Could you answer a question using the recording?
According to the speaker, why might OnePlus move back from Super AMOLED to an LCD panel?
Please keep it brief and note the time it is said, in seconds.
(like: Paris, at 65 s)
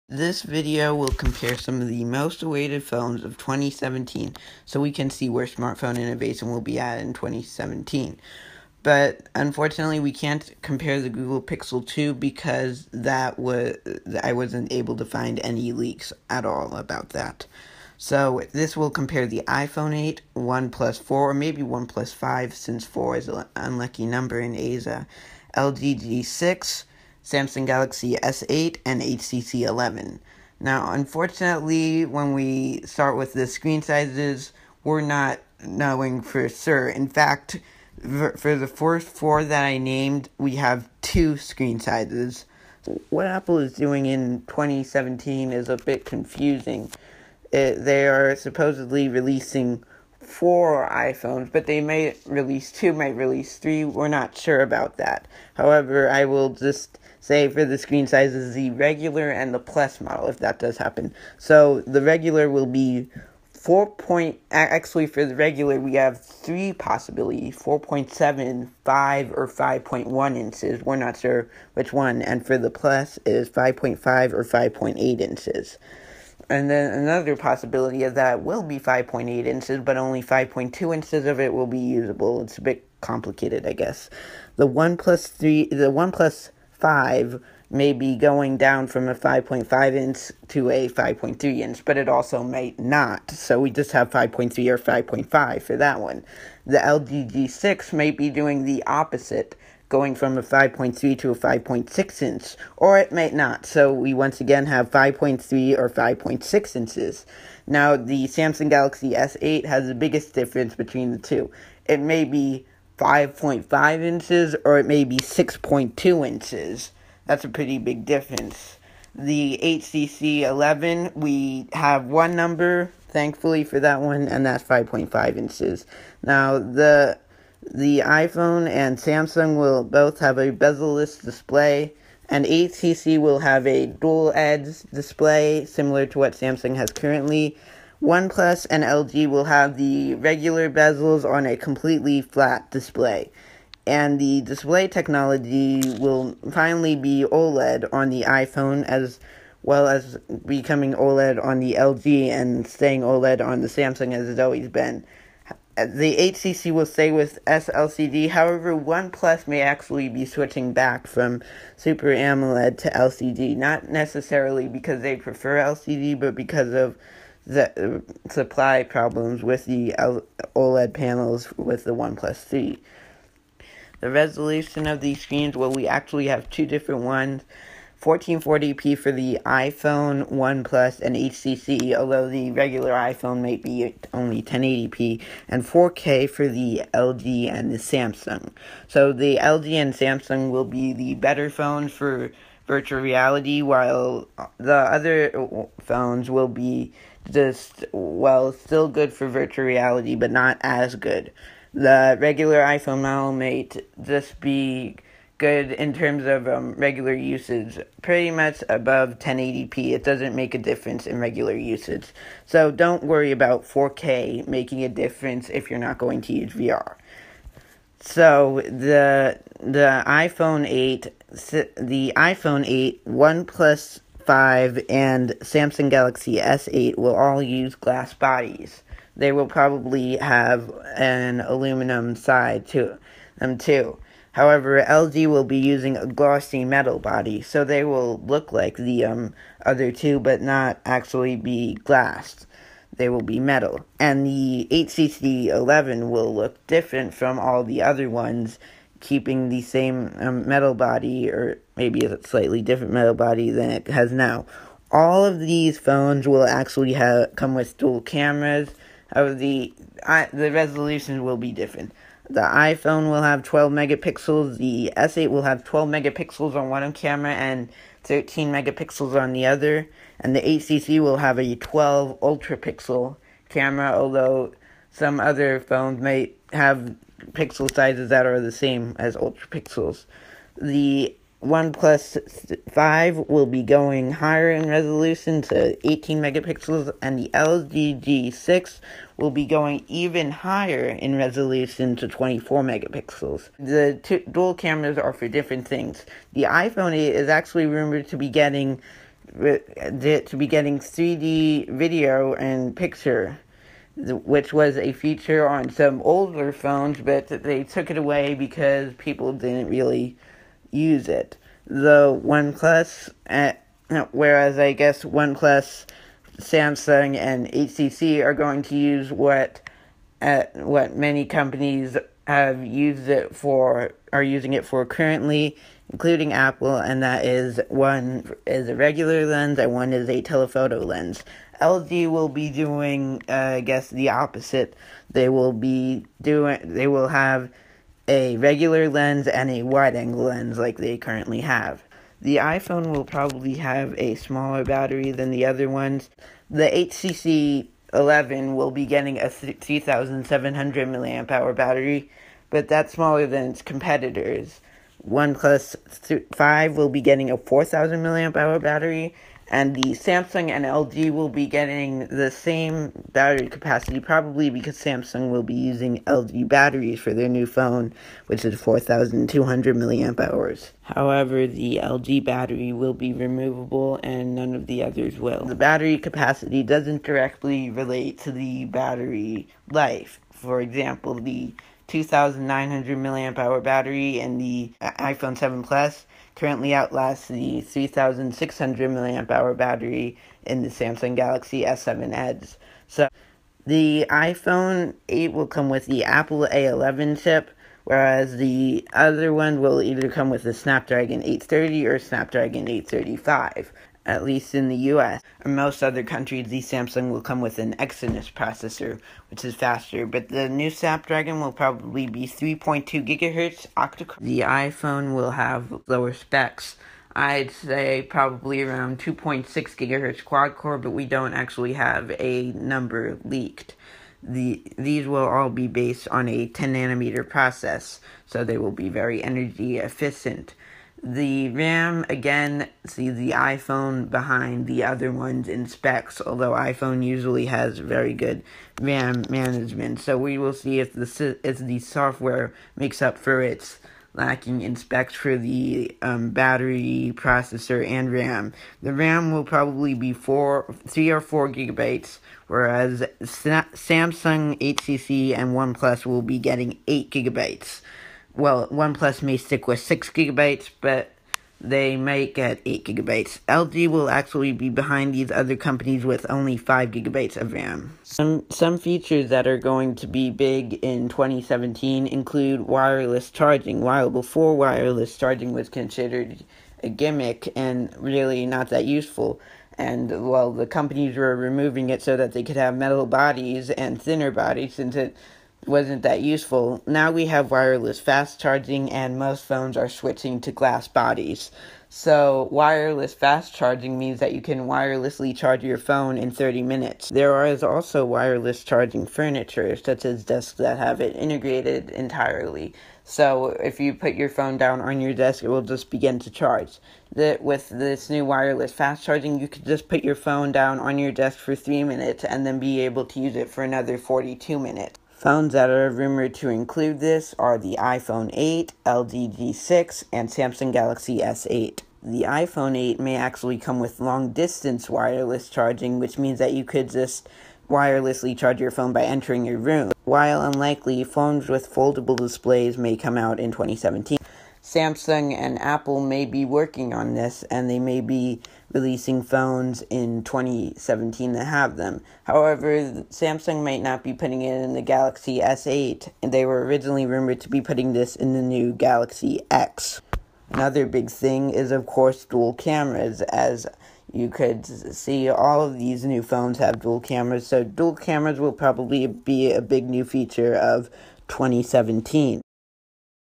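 Supply problems, at 168 s.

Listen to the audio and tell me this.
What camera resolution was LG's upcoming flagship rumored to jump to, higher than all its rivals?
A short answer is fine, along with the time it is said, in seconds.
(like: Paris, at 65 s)
24 megapixels, at 292 s.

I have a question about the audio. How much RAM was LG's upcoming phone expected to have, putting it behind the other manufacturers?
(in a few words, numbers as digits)
5 GB.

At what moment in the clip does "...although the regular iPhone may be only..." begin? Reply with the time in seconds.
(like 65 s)
181 s.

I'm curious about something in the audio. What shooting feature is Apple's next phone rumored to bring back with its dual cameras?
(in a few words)
3D video and picture.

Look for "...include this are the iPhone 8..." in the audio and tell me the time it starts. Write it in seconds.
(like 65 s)
516 s.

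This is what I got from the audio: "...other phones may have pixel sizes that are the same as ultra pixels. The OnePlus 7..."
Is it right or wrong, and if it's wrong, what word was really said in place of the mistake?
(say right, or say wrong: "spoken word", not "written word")
wrong: "5", not "7".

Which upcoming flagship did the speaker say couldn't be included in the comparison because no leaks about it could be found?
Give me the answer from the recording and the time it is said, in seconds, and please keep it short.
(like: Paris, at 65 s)
Google Pixel 2, at 11 s.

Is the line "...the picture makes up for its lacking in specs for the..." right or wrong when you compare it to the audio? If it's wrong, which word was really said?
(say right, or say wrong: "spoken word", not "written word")
wrong: "software", not "picture".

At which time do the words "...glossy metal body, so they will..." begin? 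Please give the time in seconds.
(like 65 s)
236 s.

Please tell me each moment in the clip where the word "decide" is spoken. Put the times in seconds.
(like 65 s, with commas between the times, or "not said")
not said.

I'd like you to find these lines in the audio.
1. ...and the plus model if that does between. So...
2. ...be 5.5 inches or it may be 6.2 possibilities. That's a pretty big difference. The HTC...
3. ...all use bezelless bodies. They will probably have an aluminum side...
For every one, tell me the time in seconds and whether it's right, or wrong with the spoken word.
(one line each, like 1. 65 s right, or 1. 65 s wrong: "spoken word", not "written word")
1. 59 s wrong: "happen", not "between"
2. 112 s wrong: "inches", not "possibilities"
3. 227 s wrong: "glass", not "bezelless".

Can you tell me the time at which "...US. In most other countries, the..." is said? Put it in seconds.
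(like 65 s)
404 s.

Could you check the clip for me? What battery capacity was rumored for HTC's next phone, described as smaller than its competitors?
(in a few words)
3700 mAh.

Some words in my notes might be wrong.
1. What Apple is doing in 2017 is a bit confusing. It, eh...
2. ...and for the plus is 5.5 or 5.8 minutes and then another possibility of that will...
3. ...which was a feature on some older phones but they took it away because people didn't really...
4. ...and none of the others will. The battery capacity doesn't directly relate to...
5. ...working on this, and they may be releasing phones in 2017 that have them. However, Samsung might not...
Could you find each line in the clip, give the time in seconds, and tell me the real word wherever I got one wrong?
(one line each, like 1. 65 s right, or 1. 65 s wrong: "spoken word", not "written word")
1. 43 s right
2. 72 s wrong: "inches", not "minutes"
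3. 303 s right
4. 374 s right
5. 536 s right.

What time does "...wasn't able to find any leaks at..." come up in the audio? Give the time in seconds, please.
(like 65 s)
14 s.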